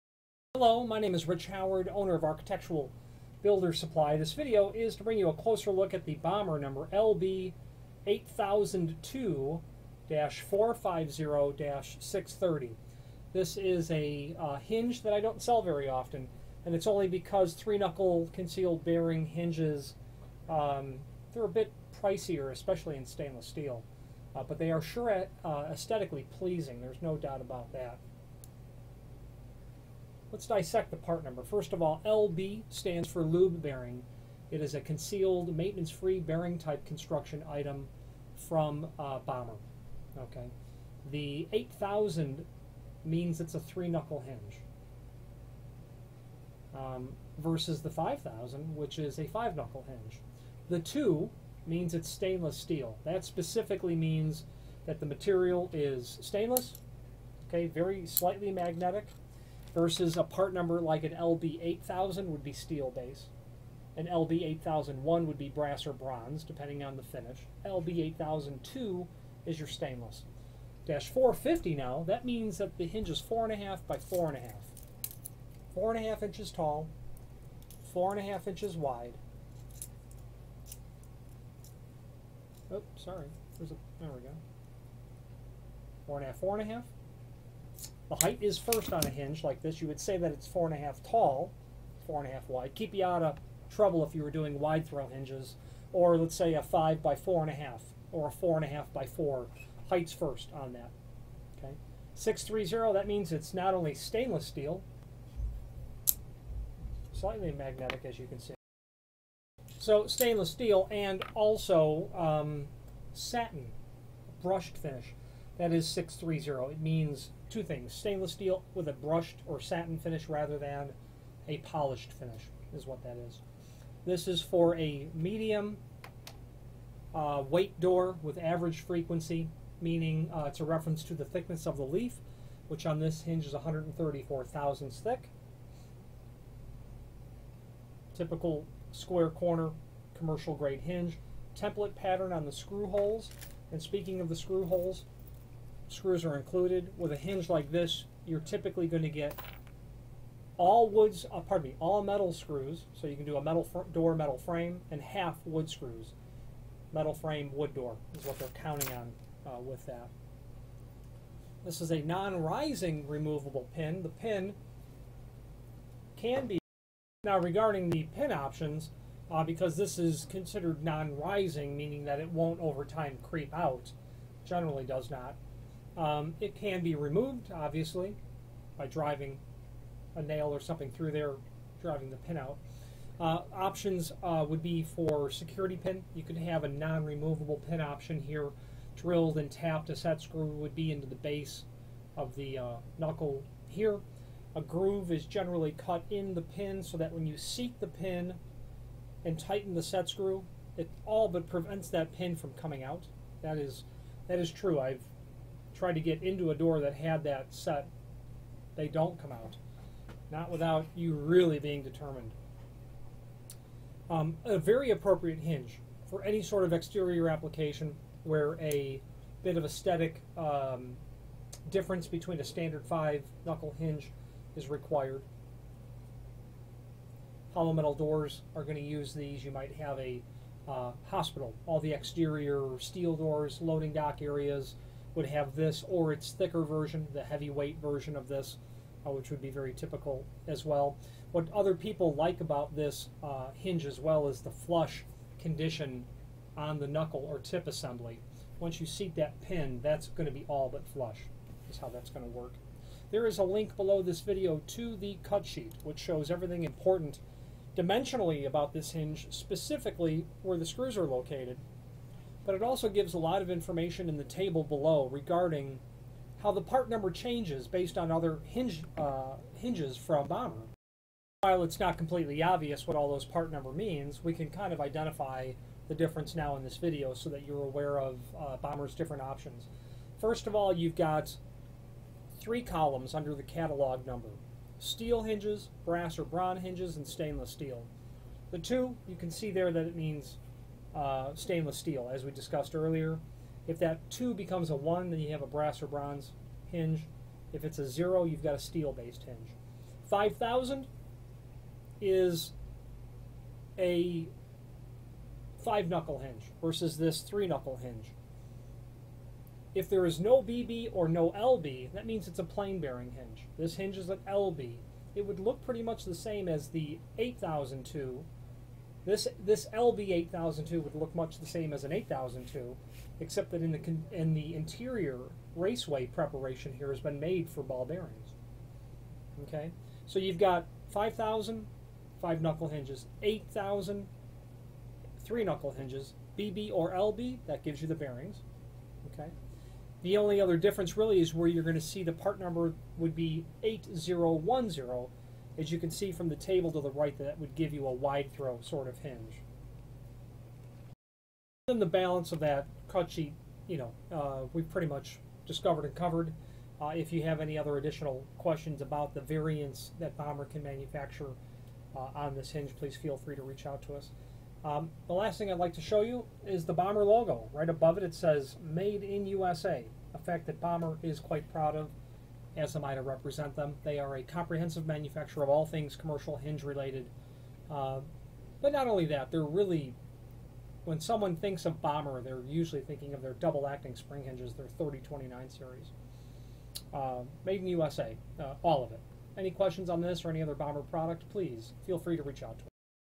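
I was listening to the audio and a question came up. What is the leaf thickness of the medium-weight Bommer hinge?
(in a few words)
134 thousandths.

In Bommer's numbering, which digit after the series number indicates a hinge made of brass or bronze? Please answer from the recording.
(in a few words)
1.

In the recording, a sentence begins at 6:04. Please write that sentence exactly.
Um, the last thing I'd like to show you is the Bommer logo.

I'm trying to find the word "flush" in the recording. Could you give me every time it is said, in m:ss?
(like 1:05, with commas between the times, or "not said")
4:04, 4:10.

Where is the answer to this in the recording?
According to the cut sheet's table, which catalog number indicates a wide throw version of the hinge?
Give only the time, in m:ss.
5:43.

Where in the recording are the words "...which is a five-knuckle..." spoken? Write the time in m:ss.
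0:48.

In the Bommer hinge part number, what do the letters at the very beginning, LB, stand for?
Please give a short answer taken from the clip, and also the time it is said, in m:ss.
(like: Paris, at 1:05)
lube bearing, at 0:33.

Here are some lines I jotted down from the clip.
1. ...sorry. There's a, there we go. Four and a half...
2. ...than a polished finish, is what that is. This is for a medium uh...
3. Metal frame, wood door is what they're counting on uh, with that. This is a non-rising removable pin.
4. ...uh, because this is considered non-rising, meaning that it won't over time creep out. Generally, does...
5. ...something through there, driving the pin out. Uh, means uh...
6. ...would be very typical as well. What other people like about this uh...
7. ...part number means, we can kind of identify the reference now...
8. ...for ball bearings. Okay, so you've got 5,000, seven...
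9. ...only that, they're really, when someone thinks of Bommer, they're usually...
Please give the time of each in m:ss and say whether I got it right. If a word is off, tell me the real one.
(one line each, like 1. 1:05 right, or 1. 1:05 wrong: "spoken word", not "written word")
1. 1:22 right
2. 2:00 right
3. 2:36 right
4. 2:49 right
5. 3:00 wrong: "options", not "means"
6. 3:59 right
7. 4:33 wrong: "difference", not "reference"
8. 5:27 wrong: "five", not "seven"
9. 6:18 right.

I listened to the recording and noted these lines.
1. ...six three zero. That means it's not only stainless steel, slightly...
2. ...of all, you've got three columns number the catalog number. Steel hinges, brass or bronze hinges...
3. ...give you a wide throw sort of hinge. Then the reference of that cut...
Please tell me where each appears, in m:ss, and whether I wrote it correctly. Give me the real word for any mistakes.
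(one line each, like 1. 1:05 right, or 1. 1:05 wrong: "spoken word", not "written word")
1. 1:42 right
2. 4:40 wrong: "under", not "number"
3. 5:47 wrong: "balance", not "reference".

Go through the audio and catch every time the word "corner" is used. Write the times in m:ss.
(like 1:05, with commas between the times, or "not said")
2:19.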